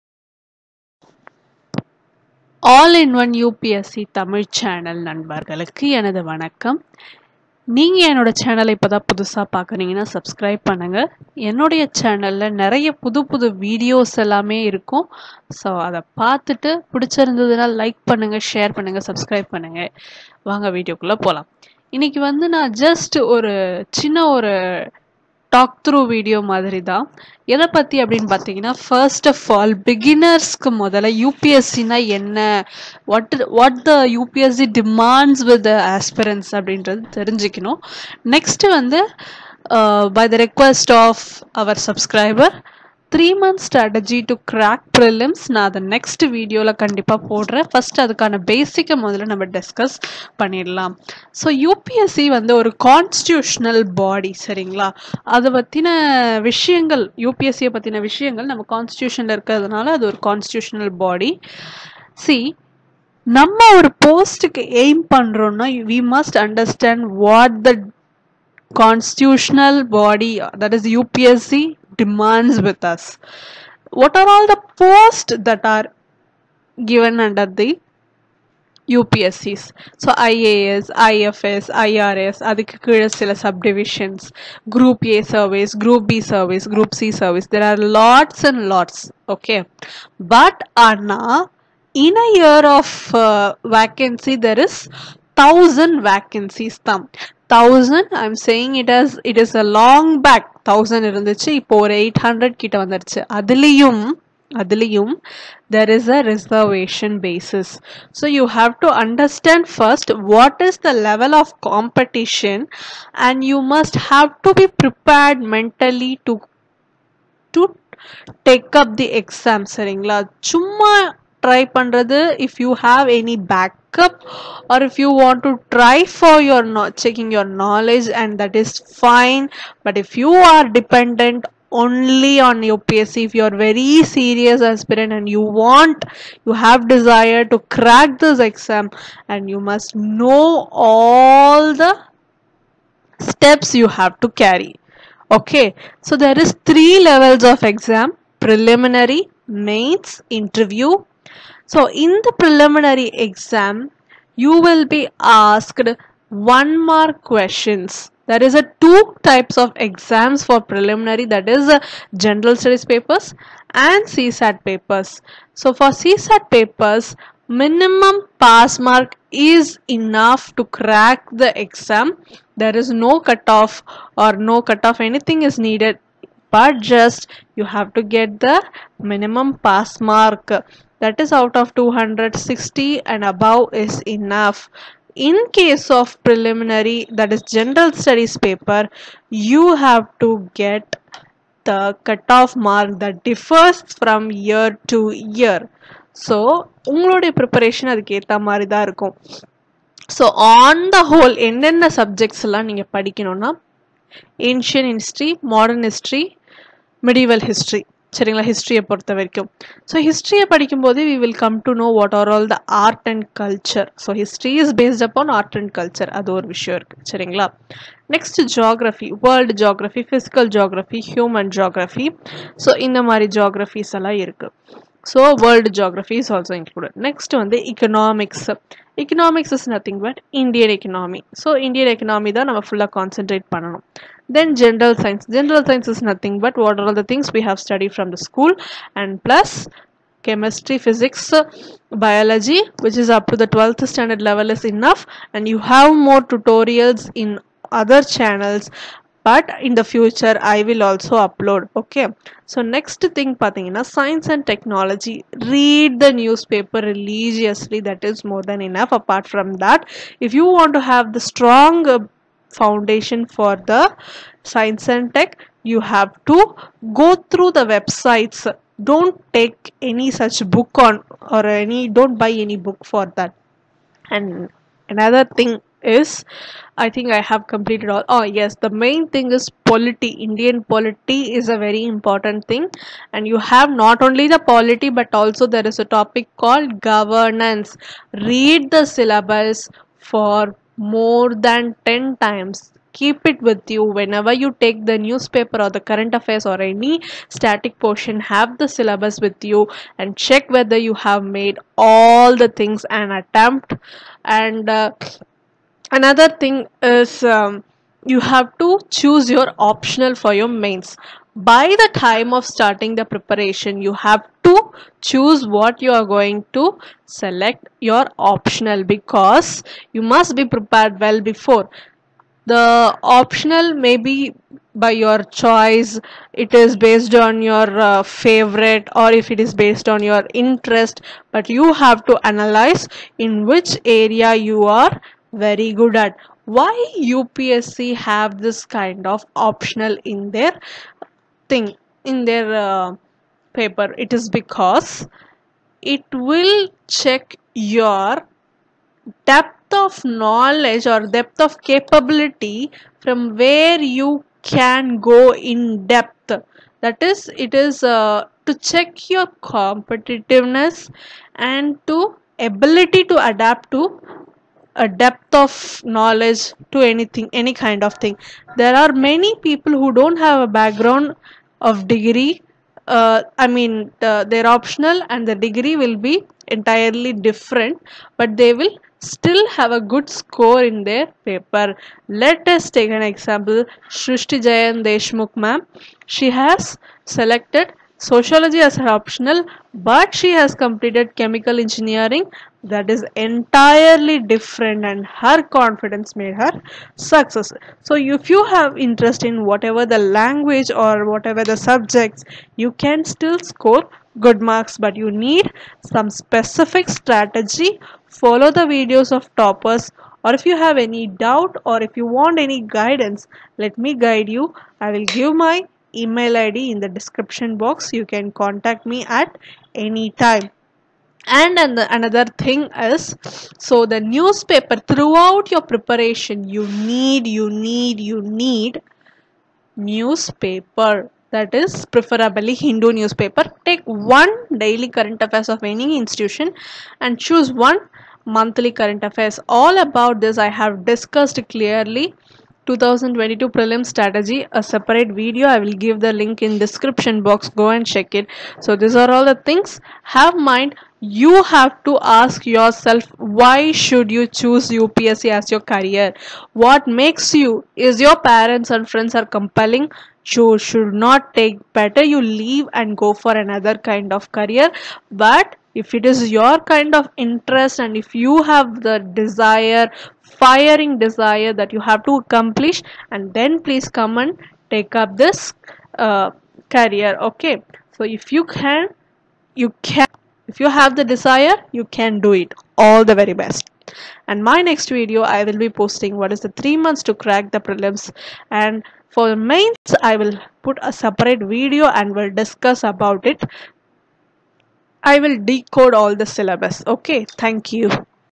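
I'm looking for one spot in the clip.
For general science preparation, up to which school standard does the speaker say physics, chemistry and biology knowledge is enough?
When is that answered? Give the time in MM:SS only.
04:03.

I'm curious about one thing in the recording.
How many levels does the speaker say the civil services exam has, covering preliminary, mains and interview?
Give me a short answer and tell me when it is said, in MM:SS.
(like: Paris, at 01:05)
3, at 02:26.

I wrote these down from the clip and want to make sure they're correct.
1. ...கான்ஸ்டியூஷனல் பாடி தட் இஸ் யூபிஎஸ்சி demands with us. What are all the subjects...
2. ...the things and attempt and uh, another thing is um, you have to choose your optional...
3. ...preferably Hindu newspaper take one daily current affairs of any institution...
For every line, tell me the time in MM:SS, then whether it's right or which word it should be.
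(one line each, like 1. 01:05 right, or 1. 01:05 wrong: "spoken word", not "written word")
1. 01:08 wrong: "posts", not "subjects"
2. 05:02 right
3. 07:11 right.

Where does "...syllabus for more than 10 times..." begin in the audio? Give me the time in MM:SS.
04:48.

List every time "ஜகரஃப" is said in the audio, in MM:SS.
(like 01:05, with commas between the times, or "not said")
03:41, 03:45.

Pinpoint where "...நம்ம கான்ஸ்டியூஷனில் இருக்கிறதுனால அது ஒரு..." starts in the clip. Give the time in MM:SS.
00:58.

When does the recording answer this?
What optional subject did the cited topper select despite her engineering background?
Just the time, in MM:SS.
06:27.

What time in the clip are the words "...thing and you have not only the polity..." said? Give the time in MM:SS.
04:42.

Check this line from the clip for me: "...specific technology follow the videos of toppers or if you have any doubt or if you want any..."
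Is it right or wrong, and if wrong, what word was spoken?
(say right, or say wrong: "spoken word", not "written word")
wrong: "strategy", not "technology".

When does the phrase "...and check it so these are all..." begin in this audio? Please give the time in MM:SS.
07:27.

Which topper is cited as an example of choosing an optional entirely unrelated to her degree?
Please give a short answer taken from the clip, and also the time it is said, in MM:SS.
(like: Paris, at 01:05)
Srushti Jayant Deshmukh, at 06:23.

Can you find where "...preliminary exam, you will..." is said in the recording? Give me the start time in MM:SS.
02:32.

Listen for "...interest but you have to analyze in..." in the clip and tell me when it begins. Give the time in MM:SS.
05:30.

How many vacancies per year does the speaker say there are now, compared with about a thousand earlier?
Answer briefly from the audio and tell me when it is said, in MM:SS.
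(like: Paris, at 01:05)
800, at 01:42.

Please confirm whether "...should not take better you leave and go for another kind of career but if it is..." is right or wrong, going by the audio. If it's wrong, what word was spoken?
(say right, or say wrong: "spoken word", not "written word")
right.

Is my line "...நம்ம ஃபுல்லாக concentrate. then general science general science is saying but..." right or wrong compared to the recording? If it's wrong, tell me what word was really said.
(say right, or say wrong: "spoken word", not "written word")
wrong: "nothing", not "saying".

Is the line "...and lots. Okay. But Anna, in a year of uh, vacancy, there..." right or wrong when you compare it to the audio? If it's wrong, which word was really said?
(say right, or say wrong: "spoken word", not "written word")
right.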